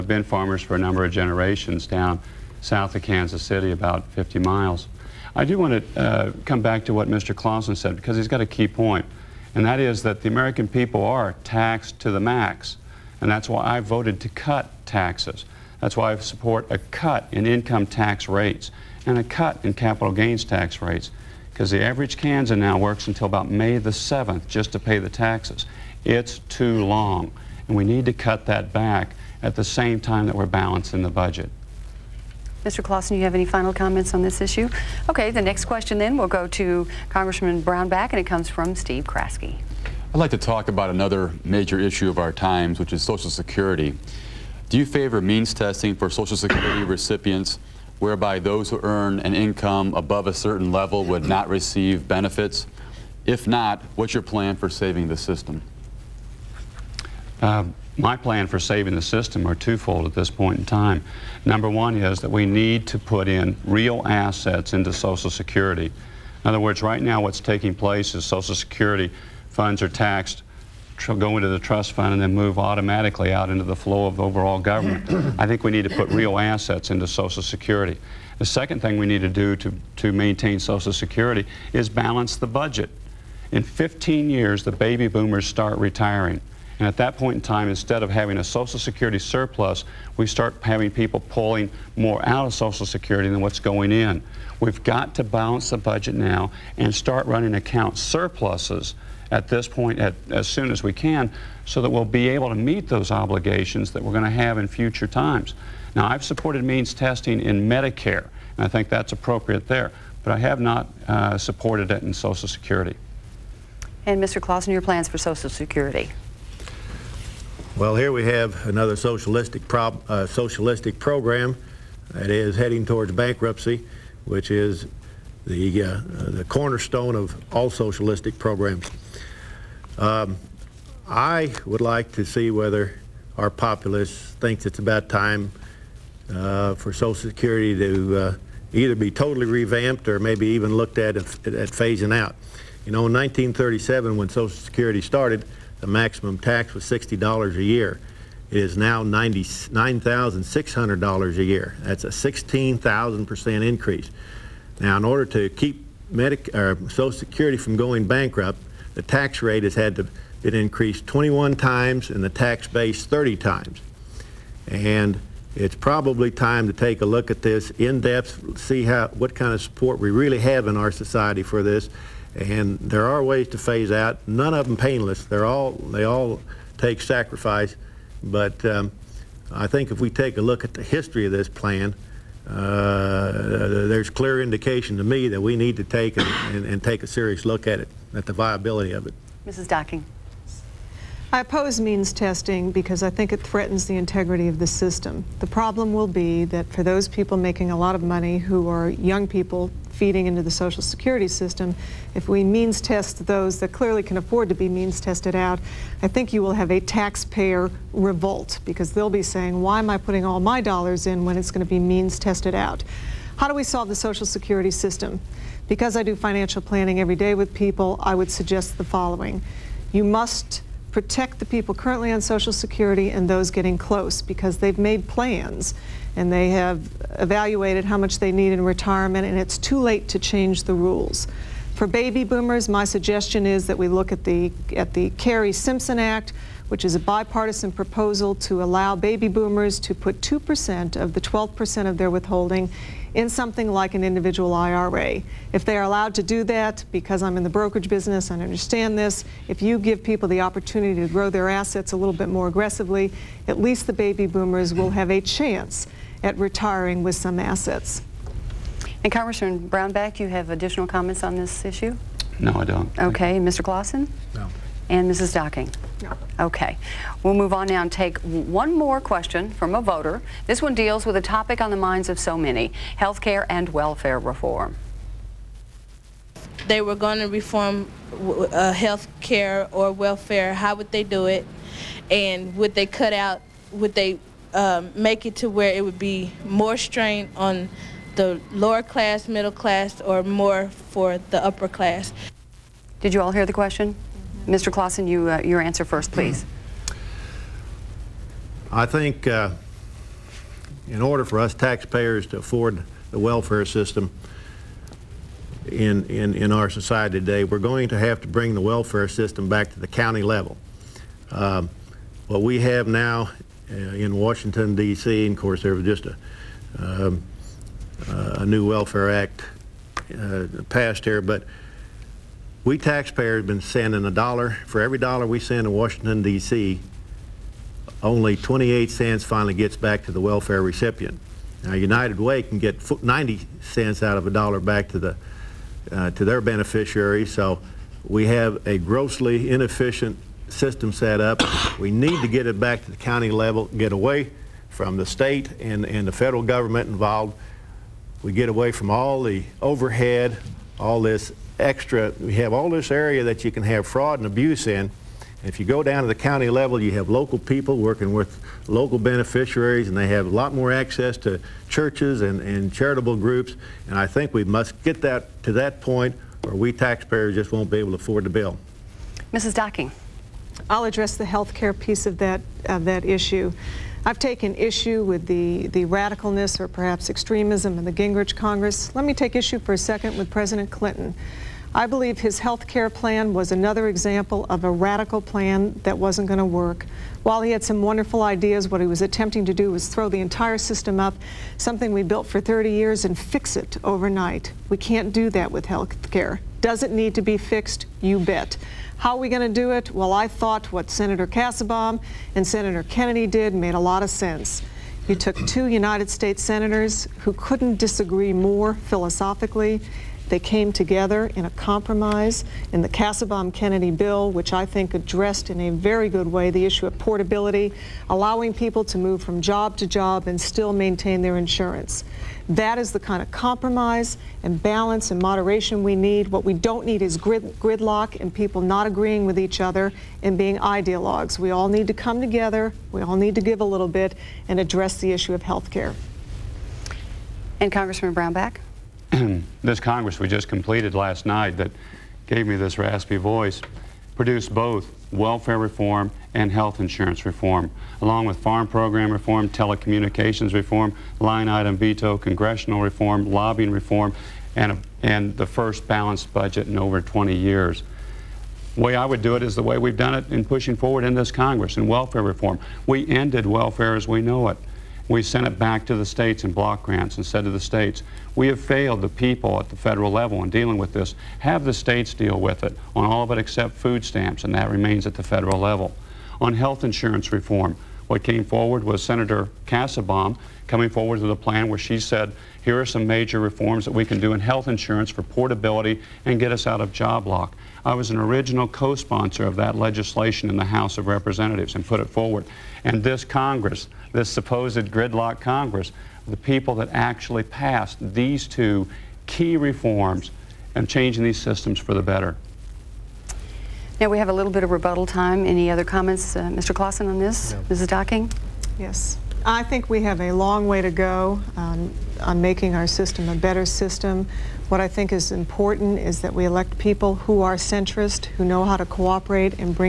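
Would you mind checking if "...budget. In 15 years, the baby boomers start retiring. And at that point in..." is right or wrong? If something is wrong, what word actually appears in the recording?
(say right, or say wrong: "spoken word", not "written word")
right.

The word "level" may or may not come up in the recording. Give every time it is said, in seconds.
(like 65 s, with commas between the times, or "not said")
50 s, 310 s, 343 s, 356 s, 470 s, 475 s.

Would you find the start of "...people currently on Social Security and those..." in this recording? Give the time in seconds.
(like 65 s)
221 s.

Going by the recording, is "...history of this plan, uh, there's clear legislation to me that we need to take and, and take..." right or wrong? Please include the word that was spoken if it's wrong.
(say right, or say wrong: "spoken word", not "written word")
wrong: "indication", not "legislation".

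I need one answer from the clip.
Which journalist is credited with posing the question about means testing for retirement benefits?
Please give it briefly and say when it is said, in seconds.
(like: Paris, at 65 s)
Steve Kraske, at 38 s.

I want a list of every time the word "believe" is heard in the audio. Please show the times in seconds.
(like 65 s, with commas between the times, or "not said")
381 s.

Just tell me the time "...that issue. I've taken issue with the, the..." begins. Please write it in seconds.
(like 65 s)
372 s.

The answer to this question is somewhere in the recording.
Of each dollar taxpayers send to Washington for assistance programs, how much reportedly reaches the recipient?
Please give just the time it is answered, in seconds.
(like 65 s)
328 s.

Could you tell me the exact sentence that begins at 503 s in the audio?
Now we have a little bit of rebuttal time.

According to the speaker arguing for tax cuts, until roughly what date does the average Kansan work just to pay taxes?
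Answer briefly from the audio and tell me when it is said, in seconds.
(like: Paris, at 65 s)
May 7th, at 23 s.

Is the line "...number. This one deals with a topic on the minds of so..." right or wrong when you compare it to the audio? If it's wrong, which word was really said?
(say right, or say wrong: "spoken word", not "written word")
wrong: "voter", not "number".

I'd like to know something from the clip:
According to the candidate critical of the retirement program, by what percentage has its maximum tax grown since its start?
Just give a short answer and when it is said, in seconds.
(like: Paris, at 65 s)
16,000%, at 152 s.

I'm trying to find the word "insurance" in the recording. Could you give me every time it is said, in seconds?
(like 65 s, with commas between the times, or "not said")
421 s, 446 s, 476 s, 484 s.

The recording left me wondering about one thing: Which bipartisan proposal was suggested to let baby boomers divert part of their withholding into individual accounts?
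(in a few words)
Kerrey-Simpson Act.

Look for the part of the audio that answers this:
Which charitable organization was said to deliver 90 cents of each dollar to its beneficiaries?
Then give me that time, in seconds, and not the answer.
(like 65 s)
331 s.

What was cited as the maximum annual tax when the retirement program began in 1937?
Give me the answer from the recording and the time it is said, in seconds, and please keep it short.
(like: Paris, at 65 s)
$60, at 146 s.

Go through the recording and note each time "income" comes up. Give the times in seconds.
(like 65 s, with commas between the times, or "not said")
17 s, 49 s.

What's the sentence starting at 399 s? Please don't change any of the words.
Well, I thought what Senator Kassebaum and Senator Kennedy did made a lot of sense.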